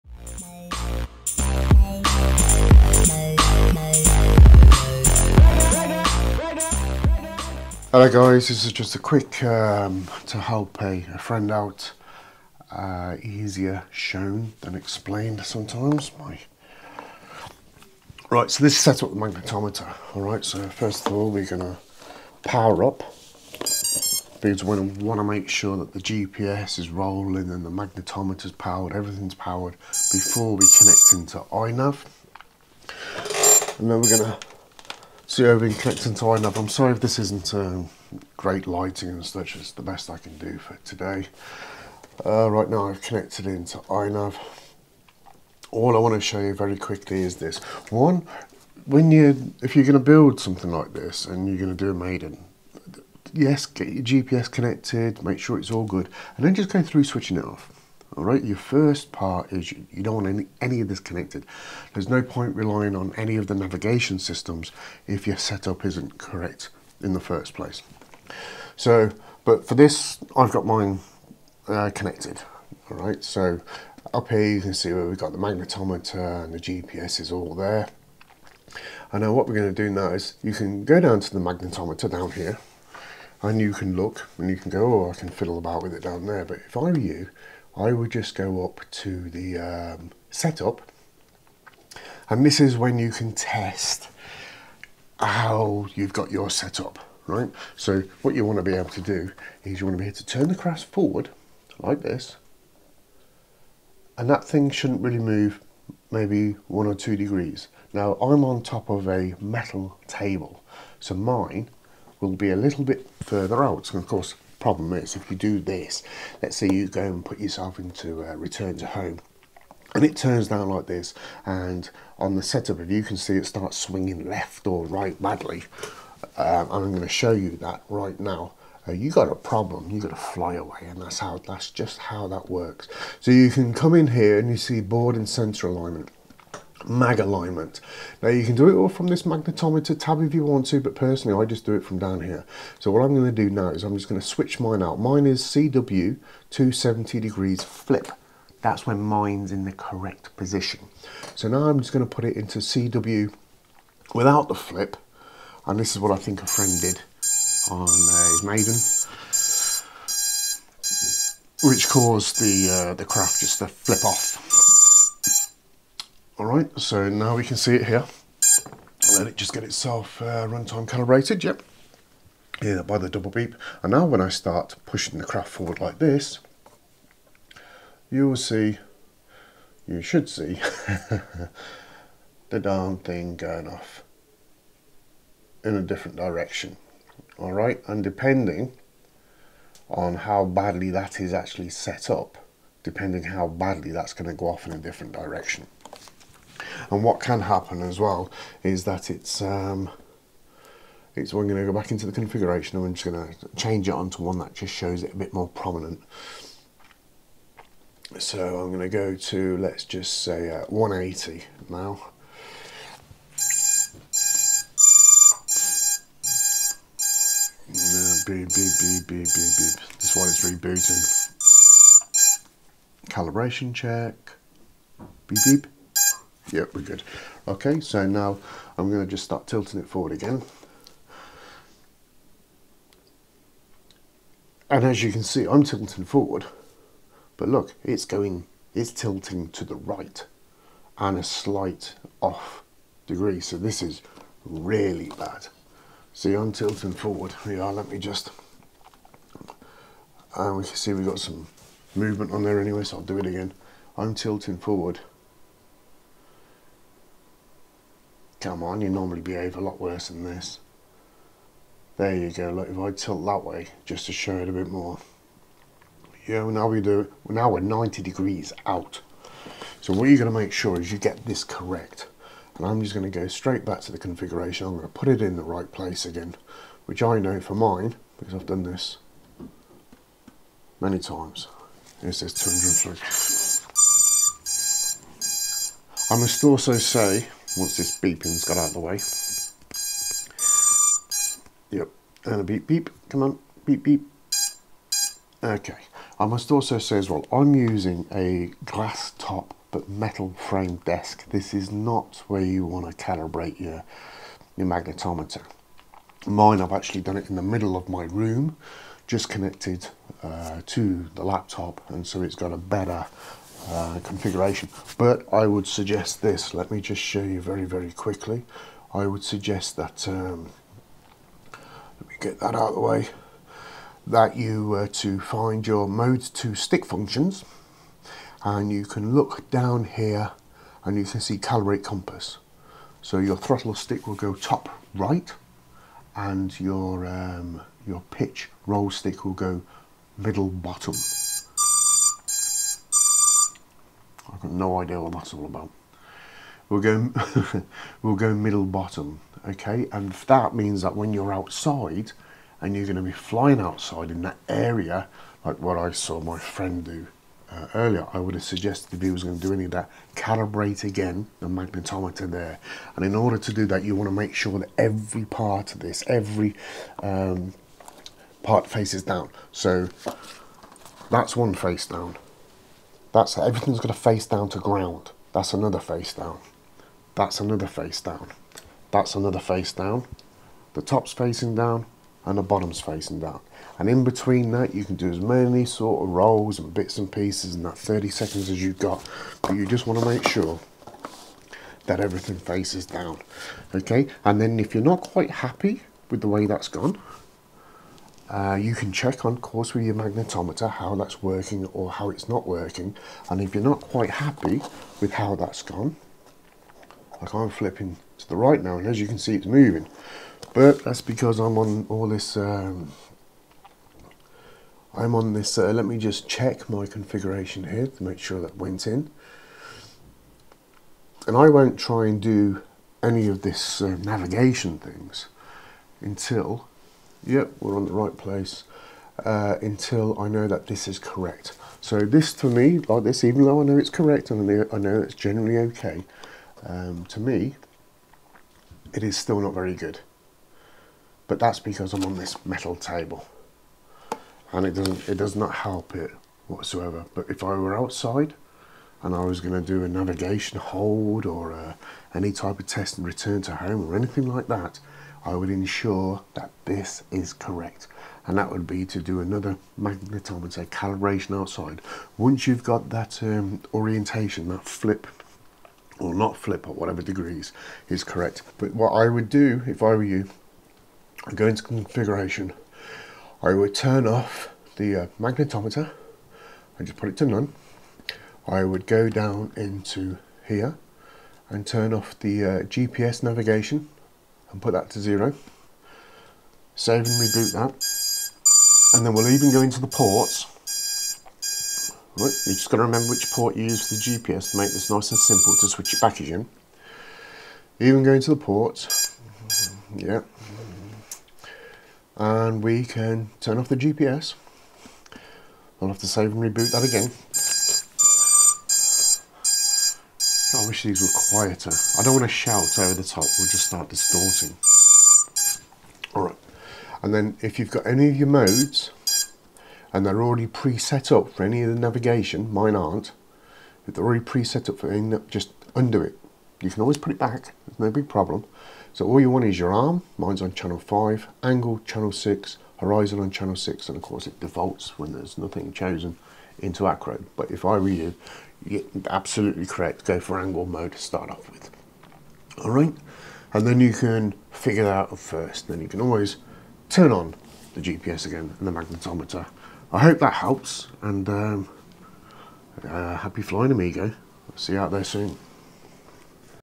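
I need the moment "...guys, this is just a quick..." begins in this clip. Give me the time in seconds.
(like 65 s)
8 s.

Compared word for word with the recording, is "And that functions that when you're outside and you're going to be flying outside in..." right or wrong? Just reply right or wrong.
wrong.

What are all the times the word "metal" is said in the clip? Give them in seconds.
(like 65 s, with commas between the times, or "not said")
109 s, 299 s, 442 s.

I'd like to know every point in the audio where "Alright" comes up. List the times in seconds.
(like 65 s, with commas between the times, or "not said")
516 s.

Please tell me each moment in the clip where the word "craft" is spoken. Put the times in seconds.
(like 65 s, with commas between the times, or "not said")
100 s, 163 s, 175 s.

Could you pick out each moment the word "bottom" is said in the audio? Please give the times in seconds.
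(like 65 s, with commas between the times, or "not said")
340 s, 348 s, 382 s.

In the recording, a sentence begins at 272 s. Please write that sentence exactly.
And I'm just gonna go straight back to the configuration.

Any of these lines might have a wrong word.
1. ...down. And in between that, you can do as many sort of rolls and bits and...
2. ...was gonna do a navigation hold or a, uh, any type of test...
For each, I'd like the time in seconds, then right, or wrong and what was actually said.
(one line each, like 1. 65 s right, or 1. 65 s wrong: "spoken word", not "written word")
1. 383 s right
2. 449 s right.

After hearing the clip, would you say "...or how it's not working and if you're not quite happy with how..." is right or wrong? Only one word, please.
right.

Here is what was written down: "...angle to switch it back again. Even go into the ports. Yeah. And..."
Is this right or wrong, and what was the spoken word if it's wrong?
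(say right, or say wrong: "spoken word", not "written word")
wrong: "simple", not "angle".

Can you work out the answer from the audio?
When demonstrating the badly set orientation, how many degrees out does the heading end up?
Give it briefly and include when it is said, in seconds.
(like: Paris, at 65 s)
90 degrees, at 267 s.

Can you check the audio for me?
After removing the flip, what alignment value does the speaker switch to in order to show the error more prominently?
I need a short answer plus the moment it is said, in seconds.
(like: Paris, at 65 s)
180, at 210 s.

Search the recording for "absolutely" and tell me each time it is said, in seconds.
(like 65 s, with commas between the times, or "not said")
539 s.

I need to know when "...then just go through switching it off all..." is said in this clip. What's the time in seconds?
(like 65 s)
56 s.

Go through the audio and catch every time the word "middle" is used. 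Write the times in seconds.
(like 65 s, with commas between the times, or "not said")
307 s, 340 s, 348 s.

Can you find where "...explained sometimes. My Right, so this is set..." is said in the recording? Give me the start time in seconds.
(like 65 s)
14 s.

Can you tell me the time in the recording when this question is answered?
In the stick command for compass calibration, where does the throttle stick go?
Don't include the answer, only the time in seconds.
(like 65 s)
334 s.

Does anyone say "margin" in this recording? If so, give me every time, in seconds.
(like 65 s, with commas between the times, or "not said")
not said.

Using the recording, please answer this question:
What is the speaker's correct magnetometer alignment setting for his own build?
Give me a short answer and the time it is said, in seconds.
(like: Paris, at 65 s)
CW 270 degrees flip, at 145 s.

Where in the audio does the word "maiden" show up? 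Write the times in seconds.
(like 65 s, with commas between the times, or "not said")
51 s, 158 s.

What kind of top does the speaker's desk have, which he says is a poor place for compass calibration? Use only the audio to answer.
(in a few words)
glass top.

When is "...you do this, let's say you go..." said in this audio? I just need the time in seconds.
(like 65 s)
115 s.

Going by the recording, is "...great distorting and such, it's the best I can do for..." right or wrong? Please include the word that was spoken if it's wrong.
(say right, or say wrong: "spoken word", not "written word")
wrong: "lighting", not "distorting".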